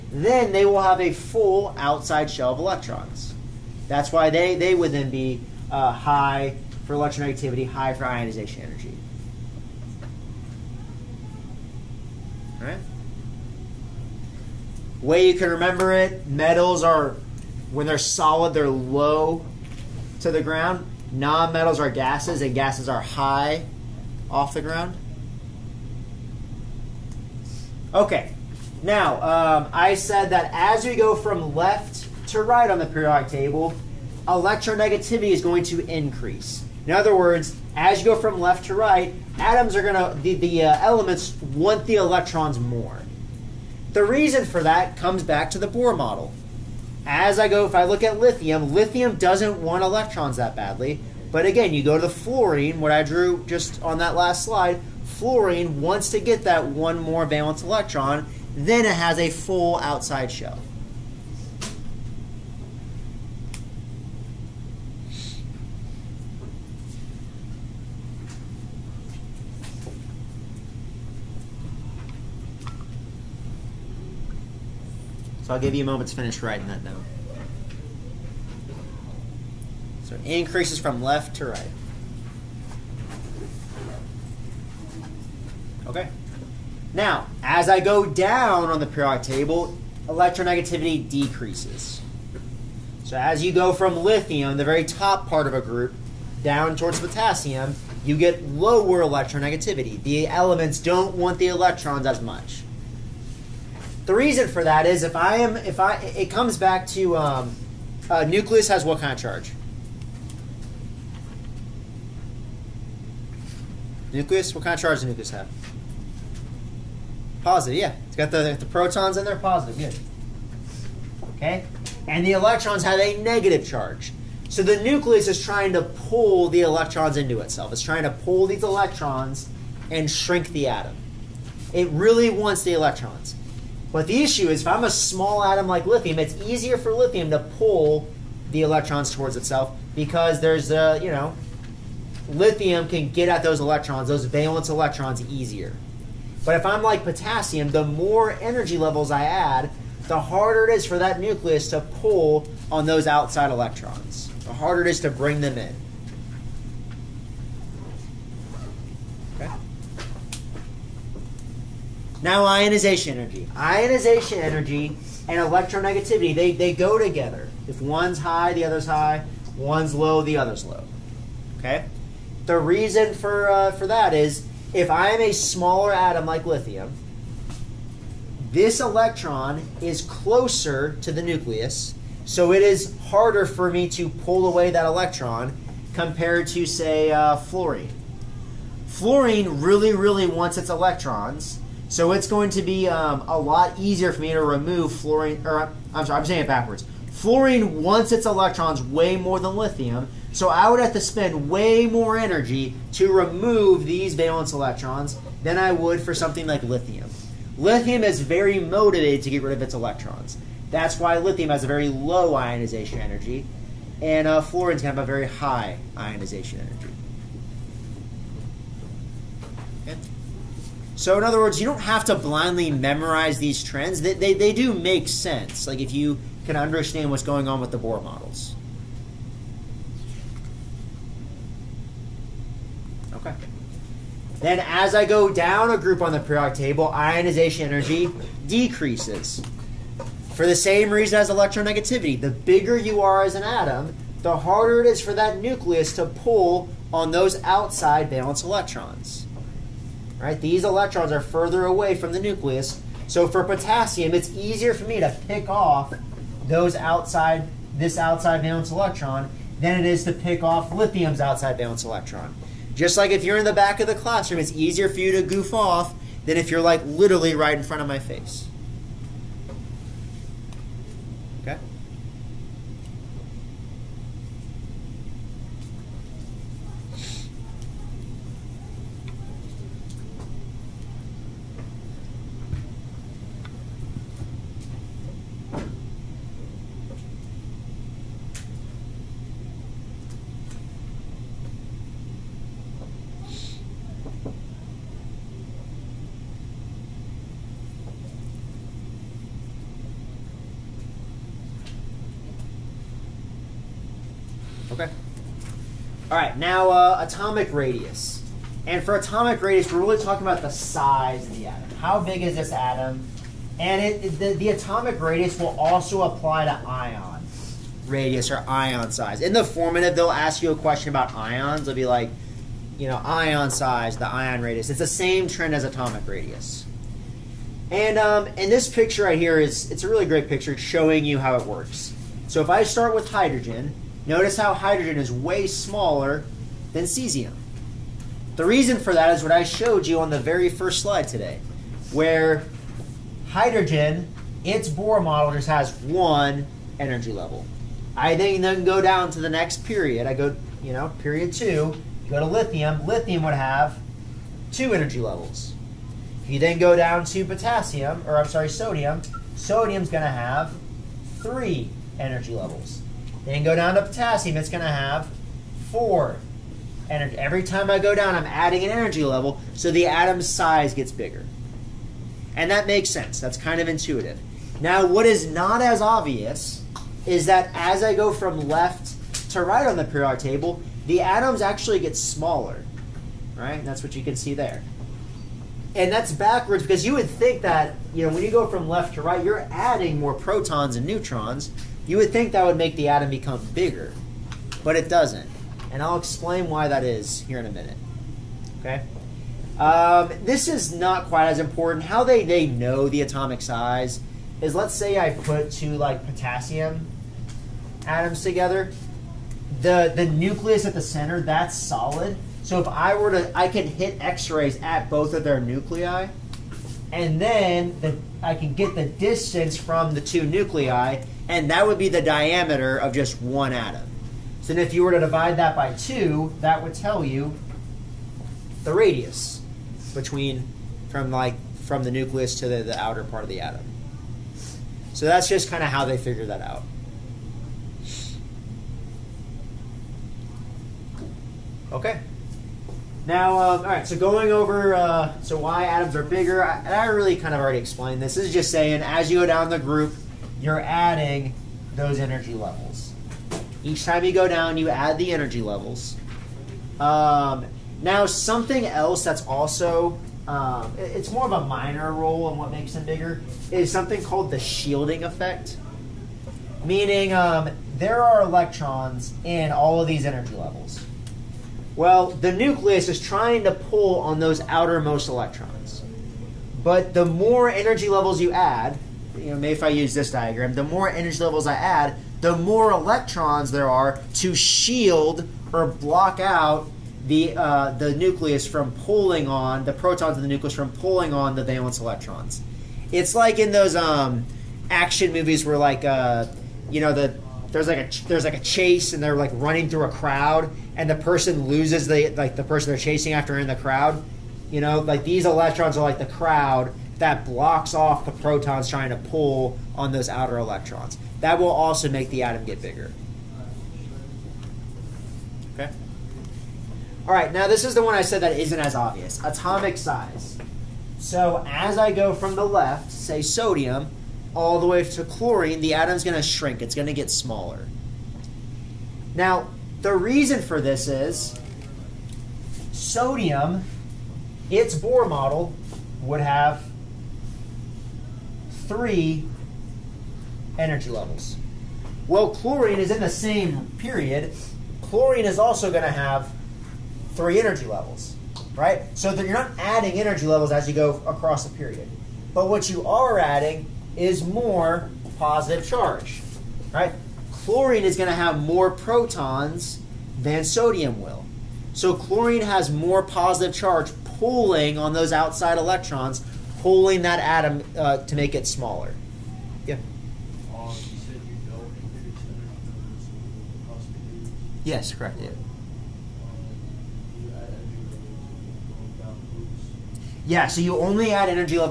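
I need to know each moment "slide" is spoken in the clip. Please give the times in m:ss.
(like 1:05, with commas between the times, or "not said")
0:54, 5:40.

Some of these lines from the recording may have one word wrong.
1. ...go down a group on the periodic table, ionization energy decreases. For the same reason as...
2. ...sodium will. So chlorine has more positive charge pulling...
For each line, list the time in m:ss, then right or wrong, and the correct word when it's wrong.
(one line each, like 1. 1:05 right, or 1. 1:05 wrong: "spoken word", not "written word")
1. 3:55 right
2. 9:20 right.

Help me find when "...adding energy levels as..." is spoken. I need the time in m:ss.
9:09.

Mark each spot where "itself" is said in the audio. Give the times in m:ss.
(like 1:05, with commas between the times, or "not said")
2:07, 2:19.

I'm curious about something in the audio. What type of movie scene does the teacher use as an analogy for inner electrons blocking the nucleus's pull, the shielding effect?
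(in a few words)
action movies.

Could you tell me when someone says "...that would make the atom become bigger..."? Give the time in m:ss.
6:32.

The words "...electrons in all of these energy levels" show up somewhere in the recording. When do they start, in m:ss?
7:48.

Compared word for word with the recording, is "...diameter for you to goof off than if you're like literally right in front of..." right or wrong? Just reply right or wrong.
wrong.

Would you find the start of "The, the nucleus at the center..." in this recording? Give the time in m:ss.
6:49.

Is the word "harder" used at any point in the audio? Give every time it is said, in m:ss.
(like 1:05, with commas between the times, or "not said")
2:30, 2:34, 3:03, 4:04.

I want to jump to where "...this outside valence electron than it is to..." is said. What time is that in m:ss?
4:17.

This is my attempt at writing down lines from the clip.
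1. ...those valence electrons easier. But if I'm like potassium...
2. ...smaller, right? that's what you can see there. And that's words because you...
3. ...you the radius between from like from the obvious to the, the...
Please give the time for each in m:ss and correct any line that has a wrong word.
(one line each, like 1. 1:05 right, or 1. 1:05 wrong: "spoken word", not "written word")
1. 2:24 right
2. 6:21 wrong: "backwards", not "words"
3. 7:07 wrong: "nucleus", not "obvious".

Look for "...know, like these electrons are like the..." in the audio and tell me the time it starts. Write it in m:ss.
8:24.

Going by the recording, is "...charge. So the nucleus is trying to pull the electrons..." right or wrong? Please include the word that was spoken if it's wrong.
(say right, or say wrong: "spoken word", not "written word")
right.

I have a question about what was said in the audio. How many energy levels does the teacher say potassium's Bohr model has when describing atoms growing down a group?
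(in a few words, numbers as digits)
4.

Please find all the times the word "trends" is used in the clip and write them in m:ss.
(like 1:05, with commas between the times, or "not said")
3:43, 5:25.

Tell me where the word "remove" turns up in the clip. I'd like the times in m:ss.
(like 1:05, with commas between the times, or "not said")
3:14, 3:23.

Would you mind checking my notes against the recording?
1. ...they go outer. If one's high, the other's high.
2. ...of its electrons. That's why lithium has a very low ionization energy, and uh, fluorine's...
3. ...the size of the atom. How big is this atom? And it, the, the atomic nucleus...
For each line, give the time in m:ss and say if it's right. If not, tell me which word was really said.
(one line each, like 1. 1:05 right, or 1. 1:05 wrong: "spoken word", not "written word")
1. 2:46 wrong: "together", not "outer"
2. 3:29 right
3. 5:10 wrong: "radius", not "nucleus".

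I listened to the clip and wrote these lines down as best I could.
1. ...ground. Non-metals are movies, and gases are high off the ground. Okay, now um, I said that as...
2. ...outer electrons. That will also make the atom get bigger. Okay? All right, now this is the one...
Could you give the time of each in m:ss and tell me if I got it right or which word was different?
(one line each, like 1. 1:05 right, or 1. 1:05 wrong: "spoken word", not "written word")
1. 0:20 wrong: "gases", not "movies"
2. 8:30 right.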